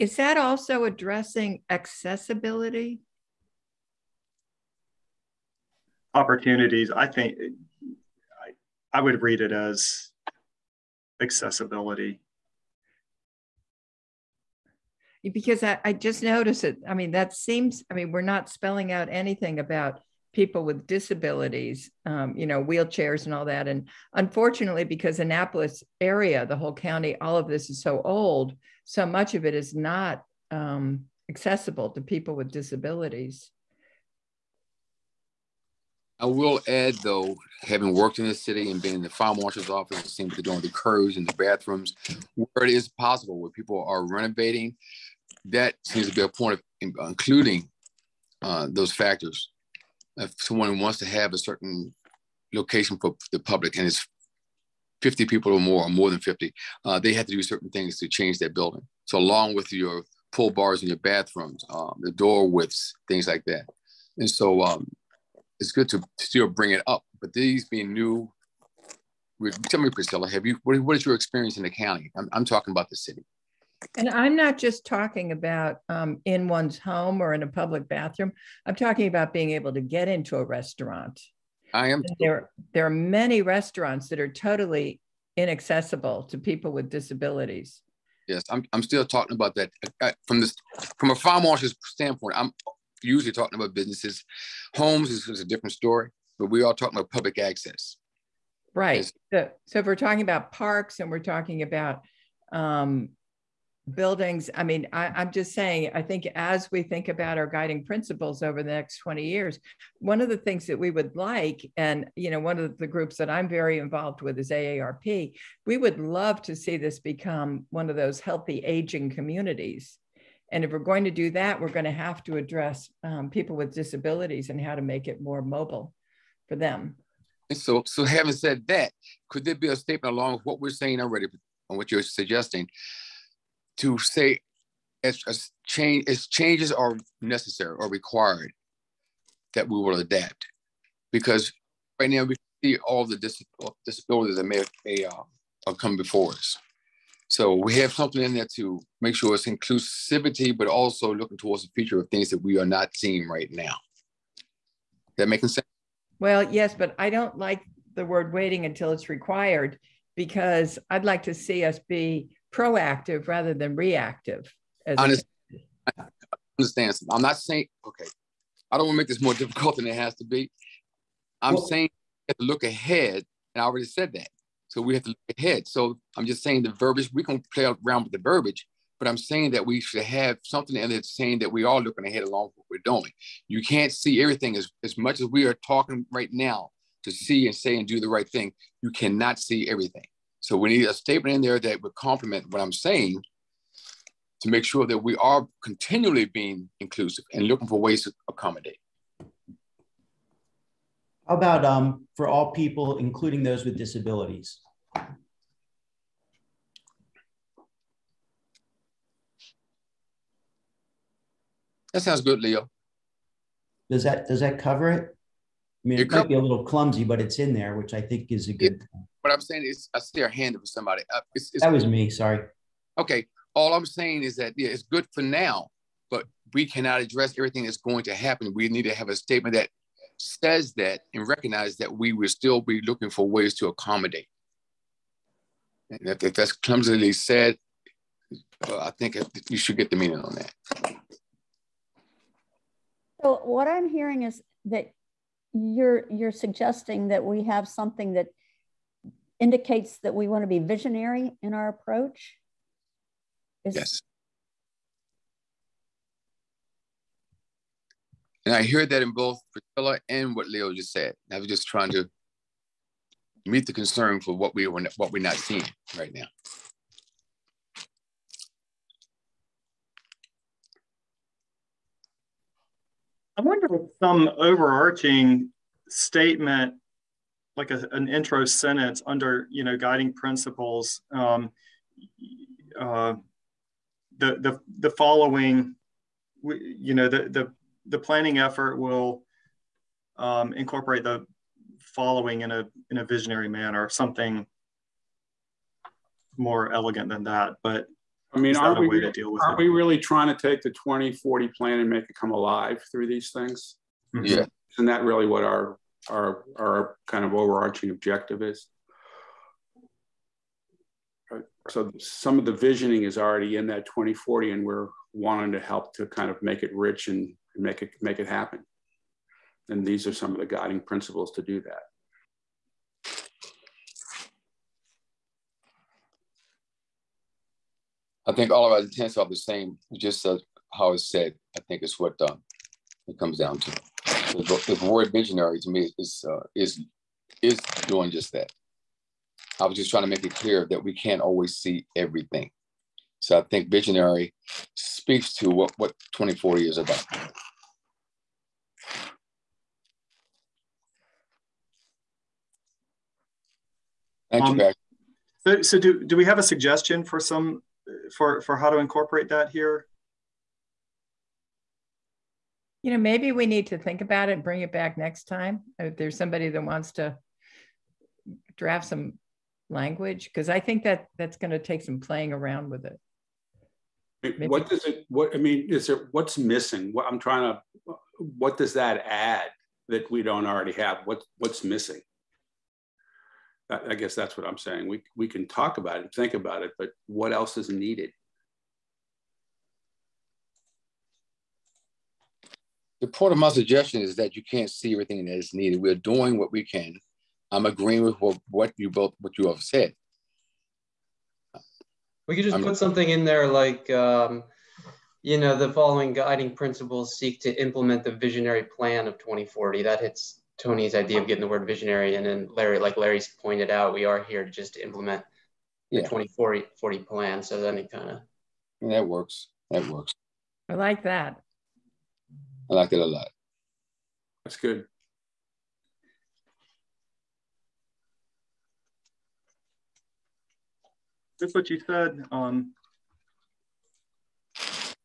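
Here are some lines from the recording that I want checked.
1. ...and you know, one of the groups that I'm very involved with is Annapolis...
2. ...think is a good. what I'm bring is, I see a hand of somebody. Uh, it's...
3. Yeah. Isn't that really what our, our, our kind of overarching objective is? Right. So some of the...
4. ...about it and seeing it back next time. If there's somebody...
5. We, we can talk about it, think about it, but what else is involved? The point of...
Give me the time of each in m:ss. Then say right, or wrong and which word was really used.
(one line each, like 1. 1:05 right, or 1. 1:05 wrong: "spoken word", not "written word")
1. 1:51 wrong: "AARP", not "Annapolis"
2. 3:38 wrong: "saying", not "bring"
3. 5:04 right
4. 6:04 wrong: "bring", not "seeing"
5. 6:24 wrong: "needed", not "involved".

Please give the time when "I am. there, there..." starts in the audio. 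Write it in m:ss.
1:21.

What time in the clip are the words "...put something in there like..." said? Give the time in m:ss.
6:42.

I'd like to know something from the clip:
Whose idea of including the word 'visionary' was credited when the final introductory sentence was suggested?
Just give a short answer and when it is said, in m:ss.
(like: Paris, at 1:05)
Tony, at 6:50.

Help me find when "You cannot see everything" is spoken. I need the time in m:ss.
3:08.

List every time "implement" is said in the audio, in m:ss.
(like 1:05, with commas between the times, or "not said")
6:47, 6:54.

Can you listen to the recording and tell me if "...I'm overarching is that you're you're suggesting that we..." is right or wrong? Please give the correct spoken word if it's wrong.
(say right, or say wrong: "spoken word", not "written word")
wrong: "hearing", not "overarching".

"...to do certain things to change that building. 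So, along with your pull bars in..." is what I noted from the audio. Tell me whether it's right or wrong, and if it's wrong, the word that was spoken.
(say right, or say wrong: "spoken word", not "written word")
right.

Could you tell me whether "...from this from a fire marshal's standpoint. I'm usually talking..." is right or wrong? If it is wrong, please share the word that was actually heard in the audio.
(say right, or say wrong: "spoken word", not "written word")
right.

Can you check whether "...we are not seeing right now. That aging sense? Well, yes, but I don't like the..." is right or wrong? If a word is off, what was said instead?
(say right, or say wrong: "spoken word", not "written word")
wrong: "making", not "aging".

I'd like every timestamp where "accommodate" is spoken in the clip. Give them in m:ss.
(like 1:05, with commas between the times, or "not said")
3:18, 3:53.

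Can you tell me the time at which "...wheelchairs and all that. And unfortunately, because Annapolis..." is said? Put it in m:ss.
0:22.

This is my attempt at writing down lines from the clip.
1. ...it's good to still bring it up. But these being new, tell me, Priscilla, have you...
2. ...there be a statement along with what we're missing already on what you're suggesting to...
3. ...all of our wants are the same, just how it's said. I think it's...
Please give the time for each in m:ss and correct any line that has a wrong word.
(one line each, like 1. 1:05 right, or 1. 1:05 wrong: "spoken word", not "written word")
1. 1:05 right
2. 2:09 wrong: "saying", not "missing"
3. 5:28 wrong: "intents", not "wants".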